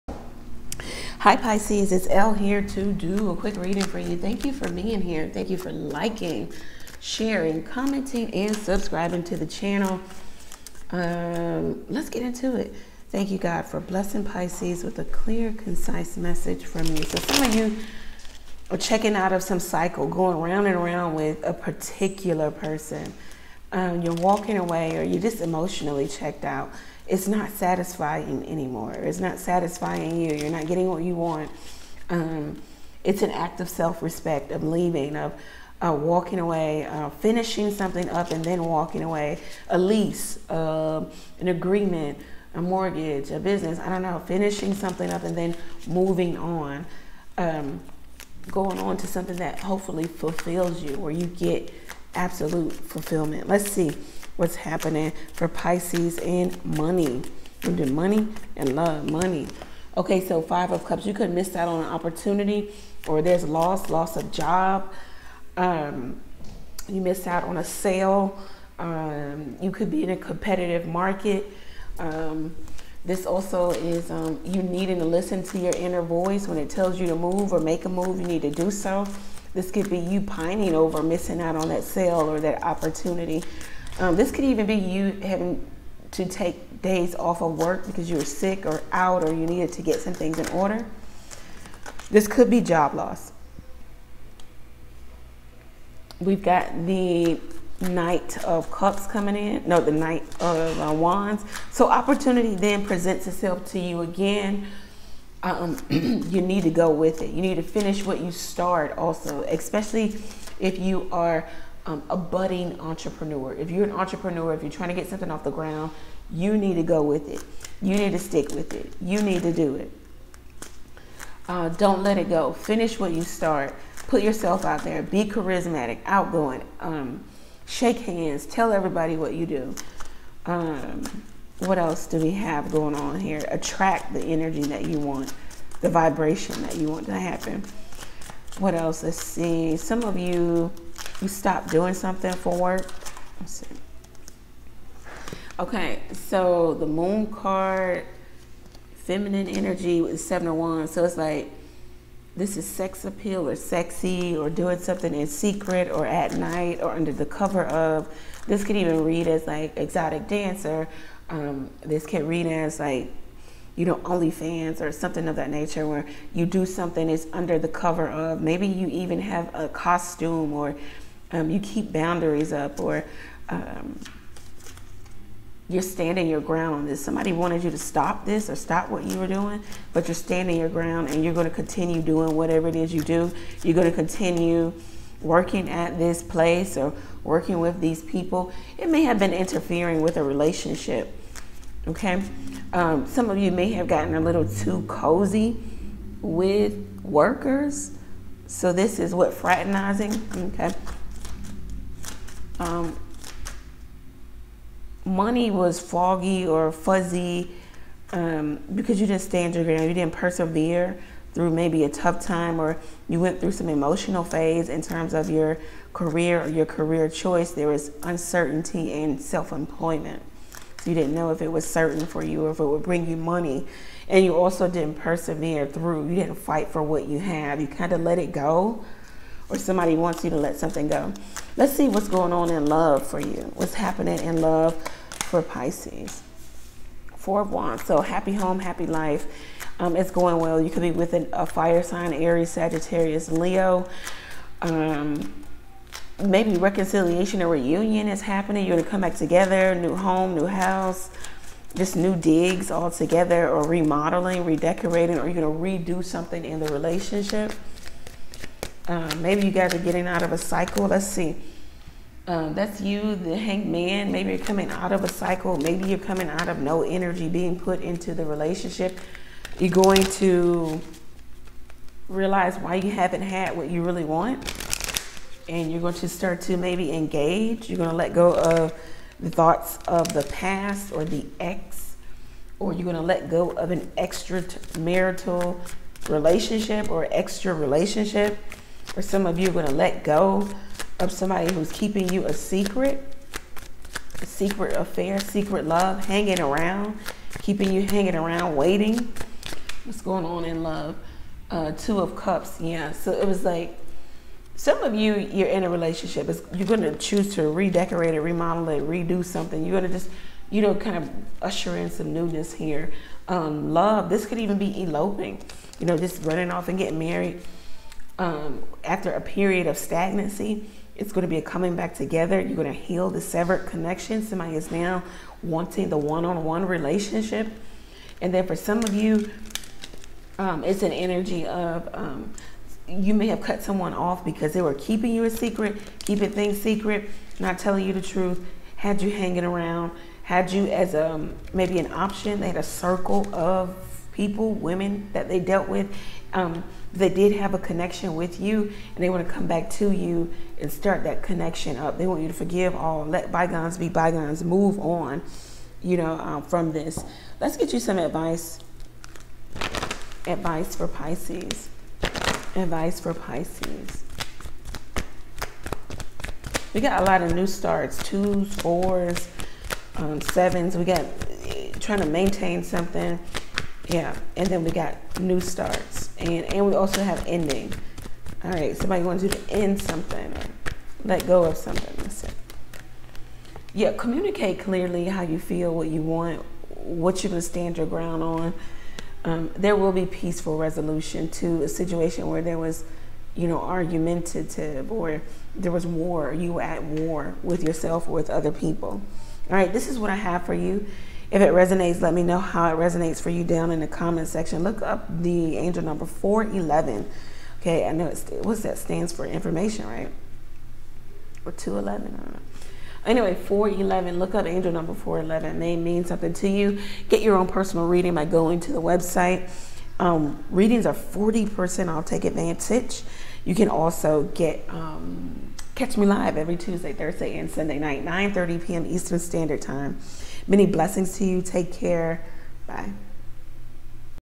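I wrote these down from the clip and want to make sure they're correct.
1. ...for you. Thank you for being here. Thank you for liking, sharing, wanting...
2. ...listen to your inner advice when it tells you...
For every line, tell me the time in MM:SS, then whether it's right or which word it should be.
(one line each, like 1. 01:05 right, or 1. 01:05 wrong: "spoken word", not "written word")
1. 00:03 wrong: "commenting", not "wanting"
2. 01:15 wrong: "voice", not "advice".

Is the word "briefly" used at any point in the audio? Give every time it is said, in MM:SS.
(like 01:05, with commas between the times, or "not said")
not said.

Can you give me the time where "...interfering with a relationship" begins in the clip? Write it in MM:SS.
03:09.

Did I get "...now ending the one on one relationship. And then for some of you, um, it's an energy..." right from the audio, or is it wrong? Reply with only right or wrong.
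wrong.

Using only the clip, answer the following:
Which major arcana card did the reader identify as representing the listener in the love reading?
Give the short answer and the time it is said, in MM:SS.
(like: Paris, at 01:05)
The Hanged Man, at 04:23.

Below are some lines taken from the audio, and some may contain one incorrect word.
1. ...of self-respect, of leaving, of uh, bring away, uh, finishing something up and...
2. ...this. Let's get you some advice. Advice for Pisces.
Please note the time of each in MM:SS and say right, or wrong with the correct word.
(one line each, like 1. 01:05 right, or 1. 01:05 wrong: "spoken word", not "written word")
1. 00:33 wrong: "walking", not "bring"
2. 05:56 right.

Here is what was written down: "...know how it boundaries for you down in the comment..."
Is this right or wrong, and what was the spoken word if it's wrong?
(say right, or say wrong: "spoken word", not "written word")
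wrong: "resonates", not "boundaries".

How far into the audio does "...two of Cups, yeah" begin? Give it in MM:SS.
05:01.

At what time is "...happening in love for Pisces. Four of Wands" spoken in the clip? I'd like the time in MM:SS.
03:53.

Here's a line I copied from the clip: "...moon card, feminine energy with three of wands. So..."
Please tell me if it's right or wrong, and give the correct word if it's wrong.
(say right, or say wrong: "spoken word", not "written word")
wrong: "seven", not "three".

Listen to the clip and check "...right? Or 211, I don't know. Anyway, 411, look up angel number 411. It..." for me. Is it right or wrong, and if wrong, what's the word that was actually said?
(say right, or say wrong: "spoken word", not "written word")
right.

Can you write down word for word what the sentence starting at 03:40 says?
So you didn't know if it was certain for you or if it would bring you money.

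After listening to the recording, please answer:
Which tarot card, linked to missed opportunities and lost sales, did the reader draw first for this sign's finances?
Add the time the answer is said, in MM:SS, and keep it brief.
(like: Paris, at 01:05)
Five of Cups, at 01:00.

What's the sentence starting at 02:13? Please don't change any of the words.
Attract the energy that you want, the vibration that you want to happen.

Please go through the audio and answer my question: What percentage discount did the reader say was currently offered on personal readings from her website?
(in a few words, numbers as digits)
40%.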